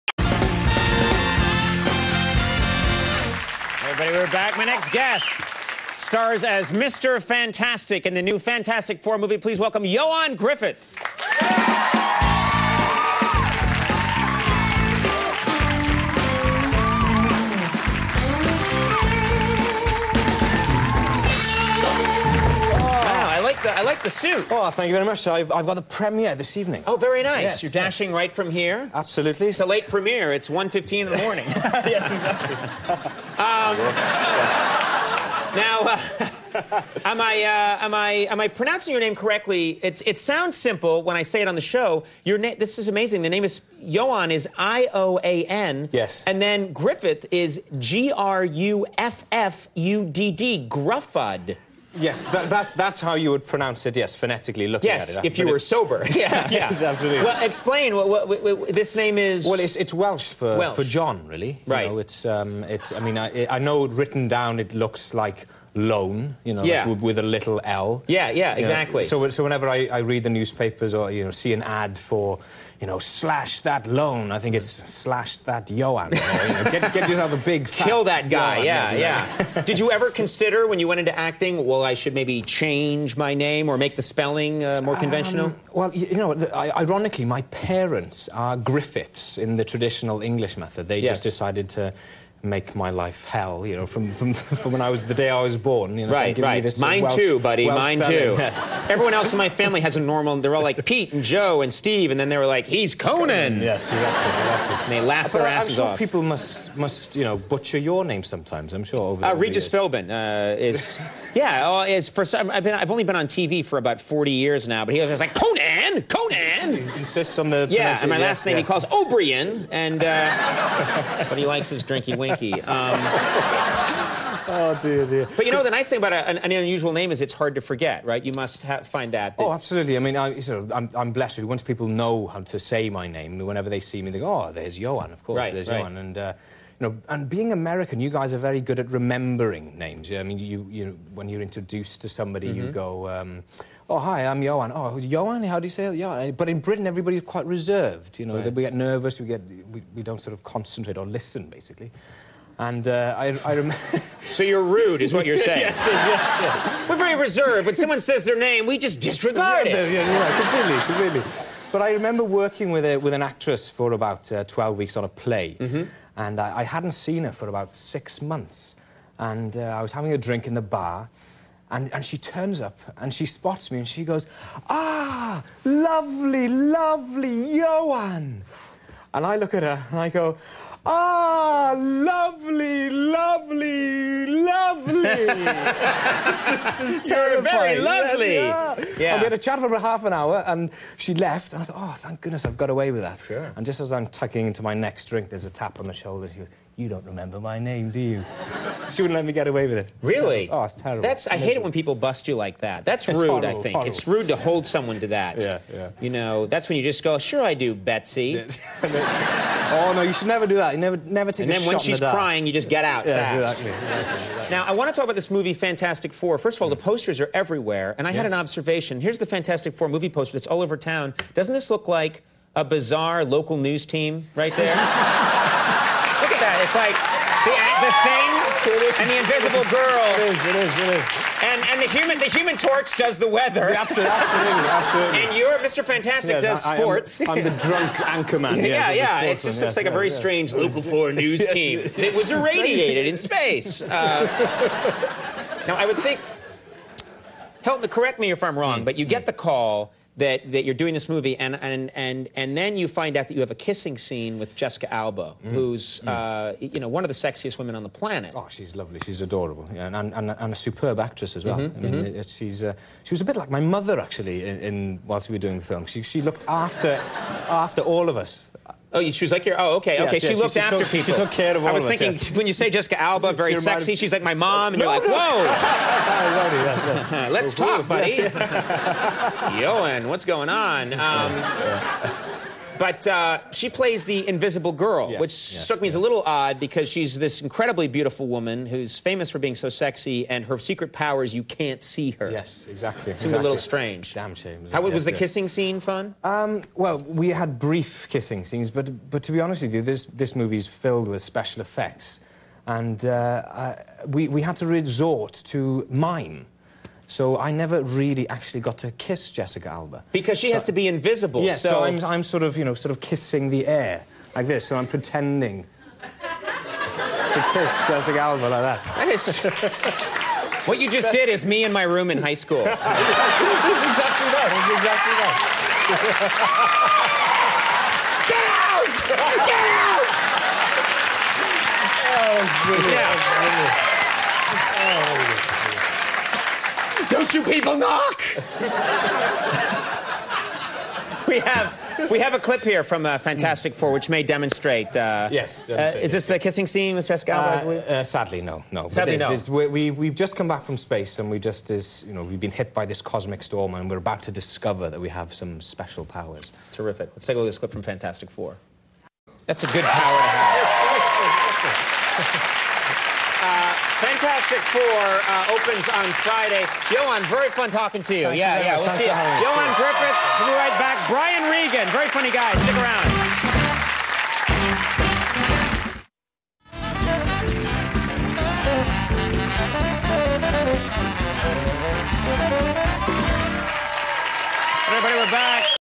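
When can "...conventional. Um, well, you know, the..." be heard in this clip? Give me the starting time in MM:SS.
01:24.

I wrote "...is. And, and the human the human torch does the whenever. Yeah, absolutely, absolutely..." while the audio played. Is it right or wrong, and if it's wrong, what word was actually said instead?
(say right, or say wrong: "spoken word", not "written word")
wrong: "weather", not "whenever".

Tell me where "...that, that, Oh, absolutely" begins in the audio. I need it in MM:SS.
02:09.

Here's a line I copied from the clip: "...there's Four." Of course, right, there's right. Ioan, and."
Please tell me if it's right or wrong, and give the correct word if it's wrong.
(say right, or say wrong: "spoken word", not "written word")
wrong: "Ioan", not "Four".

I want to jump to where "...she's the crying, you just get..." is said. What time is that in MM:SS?
03:31.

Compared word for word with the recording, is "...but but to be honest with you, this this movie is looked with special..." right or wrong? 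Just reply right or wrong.
wrong.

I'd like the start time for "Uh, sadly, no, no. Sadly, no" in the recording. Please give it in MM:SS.
05:47.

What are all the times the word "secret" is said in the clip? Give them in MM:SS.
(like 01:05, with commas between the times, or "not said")
04:50.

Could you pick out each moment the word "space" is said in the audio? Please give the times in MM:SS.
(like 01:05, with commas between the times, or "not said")
04:03, 05:50.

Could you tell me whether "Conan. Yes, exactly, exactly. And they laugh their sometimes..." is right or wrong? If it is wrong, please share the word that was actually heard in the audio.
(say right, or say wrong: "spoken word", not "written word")
wrong: "asses", not "sometimes".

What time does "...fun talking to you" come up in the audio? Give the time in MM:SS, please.
06:07.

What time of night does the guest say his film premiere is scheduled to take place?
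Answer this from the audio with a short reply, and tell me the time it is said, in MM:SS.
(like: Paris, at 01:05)
1:15 in the morning, at 00:30.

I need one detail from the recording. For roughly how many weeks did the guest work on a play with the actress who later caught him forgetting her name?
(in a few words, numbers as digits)
12.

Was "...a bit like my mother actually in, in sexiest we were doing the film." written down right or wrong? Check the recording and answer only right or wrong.
wrong.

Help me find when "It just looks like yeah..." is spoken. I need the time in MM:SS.
03:59.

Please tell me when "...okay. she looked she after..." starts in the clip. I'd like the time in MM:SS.
04:30.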